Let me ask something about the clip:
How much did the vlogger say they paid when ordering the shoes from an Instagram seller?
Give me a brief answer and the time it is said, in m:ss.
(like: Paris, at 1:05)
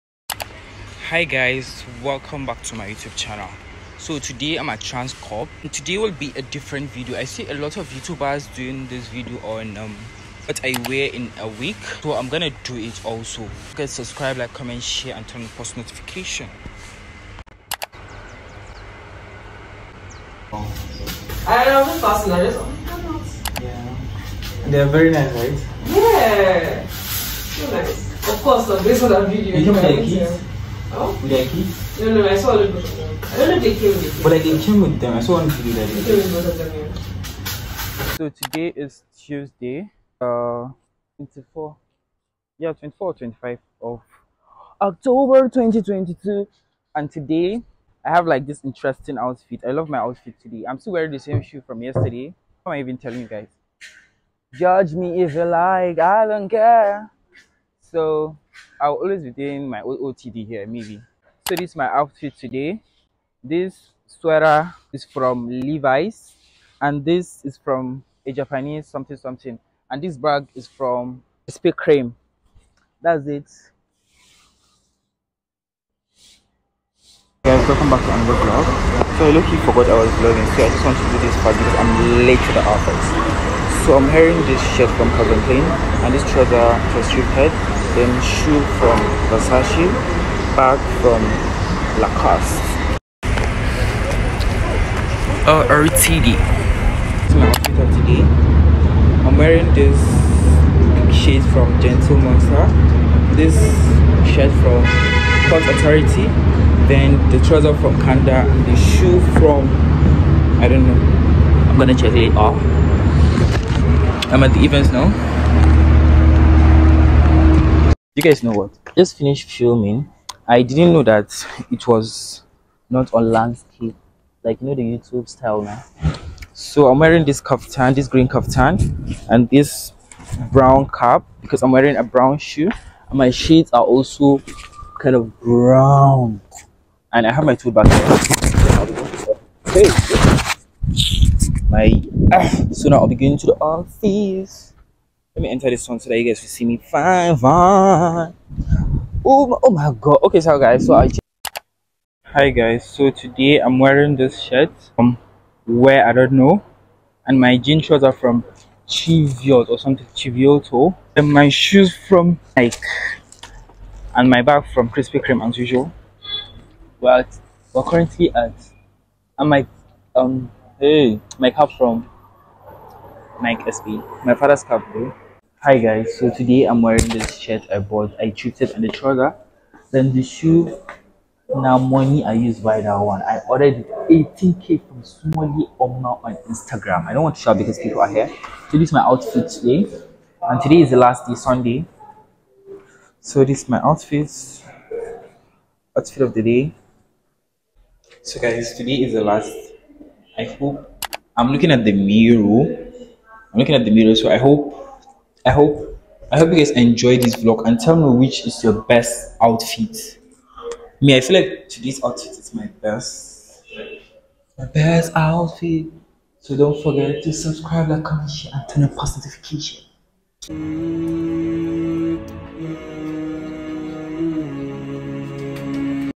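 18k, at 3:04.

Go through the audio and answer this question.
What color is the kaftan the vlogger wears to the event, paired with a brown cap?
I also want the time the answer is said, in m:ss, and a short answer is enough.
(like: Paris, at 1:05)
Green, at 2:08.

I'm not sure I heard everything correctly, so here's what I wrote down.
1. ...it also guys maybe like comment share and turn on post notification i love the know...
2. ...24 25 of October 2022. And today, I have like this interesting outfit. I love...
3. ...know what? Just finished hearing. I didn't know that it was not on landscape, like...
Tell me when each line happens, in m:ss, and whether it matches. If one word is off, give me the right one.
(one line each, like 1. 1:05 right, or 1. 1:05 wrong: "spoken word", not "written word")
1. 0:12 wrong: "subscribe", not "maybe"
2. 0:42 right
3. 1:58 wrong: "filming", not "hearing".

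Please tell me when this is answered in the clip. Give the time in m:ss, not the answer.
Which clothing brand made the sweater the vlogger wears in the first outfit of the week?
1:05.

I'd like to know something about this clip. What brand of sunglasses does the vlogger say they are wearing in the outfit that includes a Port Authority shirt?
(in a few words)
Gentle Monster.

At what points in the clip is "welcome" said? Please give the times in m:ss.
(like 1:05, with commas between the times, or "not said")
0:02, 1:17.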